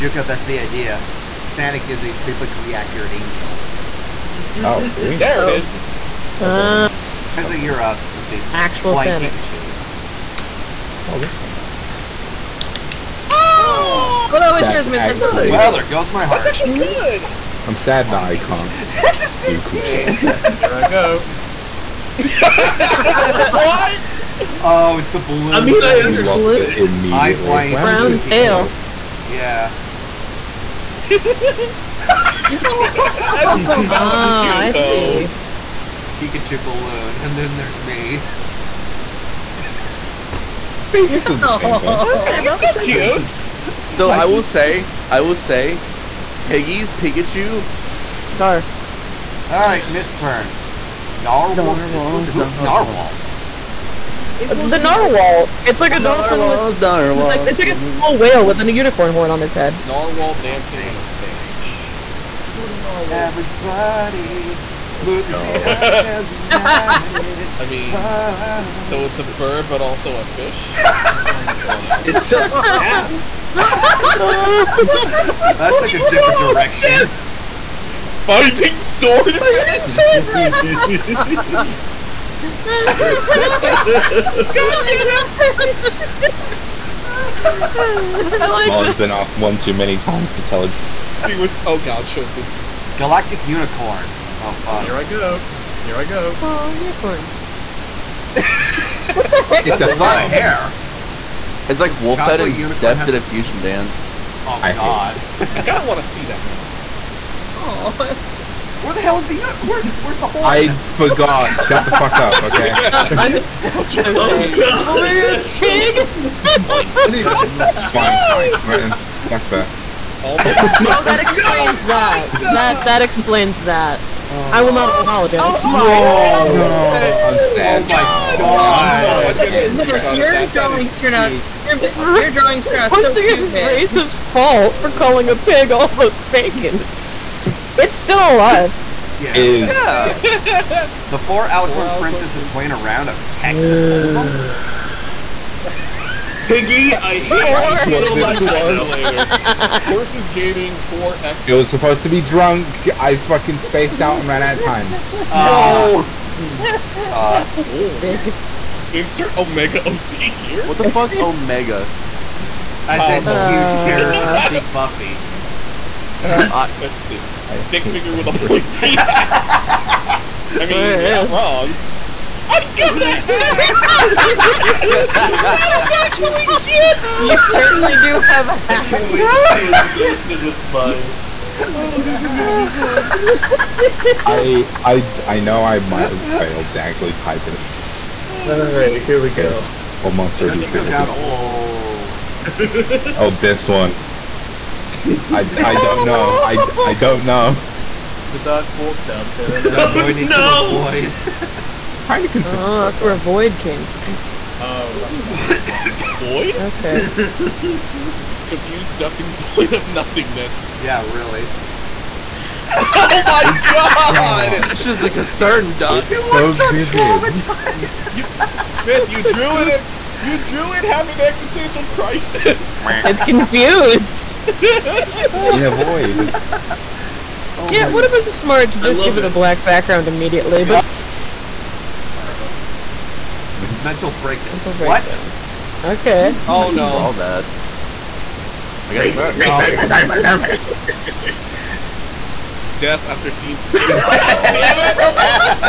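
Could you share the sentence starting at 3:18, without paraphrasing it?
The dark walked out to them.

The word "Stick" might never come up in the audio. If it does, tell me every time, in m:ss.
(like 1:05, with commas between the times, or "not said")
2:47.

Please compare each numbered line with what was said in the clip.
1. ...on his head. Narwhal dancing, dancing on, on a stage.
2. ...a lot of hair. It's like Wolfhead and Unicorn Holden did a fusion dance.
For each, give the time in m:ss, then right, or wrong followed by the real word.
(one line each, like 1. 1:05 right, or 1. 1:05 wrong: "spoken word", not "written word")
1. 0:59 right
2. 1:39 wrong: "Def", not "Holden".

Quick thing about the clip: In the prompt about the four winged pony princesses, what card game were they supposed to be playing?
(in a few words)
Texas Hold'em.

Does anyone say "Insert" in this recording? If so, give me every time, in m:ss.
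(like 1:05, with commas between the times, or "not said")
2:38.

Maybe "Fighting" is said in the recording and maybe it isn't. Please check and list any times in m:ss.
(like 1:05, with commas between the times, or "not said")
1:18.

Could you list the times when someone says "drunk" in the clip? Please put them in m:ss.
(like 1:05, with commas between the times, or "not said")
2:32.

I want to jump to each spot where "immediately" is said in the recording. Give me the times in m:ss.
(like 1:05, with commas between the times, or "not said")
0:26, 3:50.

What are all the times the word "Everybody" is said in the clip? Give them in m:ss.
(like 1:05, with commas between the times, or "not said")
1:03.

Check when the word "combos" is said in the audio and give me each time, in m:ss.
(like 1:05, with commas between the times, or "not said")
not said.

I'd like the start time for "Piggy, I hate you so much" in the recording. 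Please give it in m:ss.
2:26.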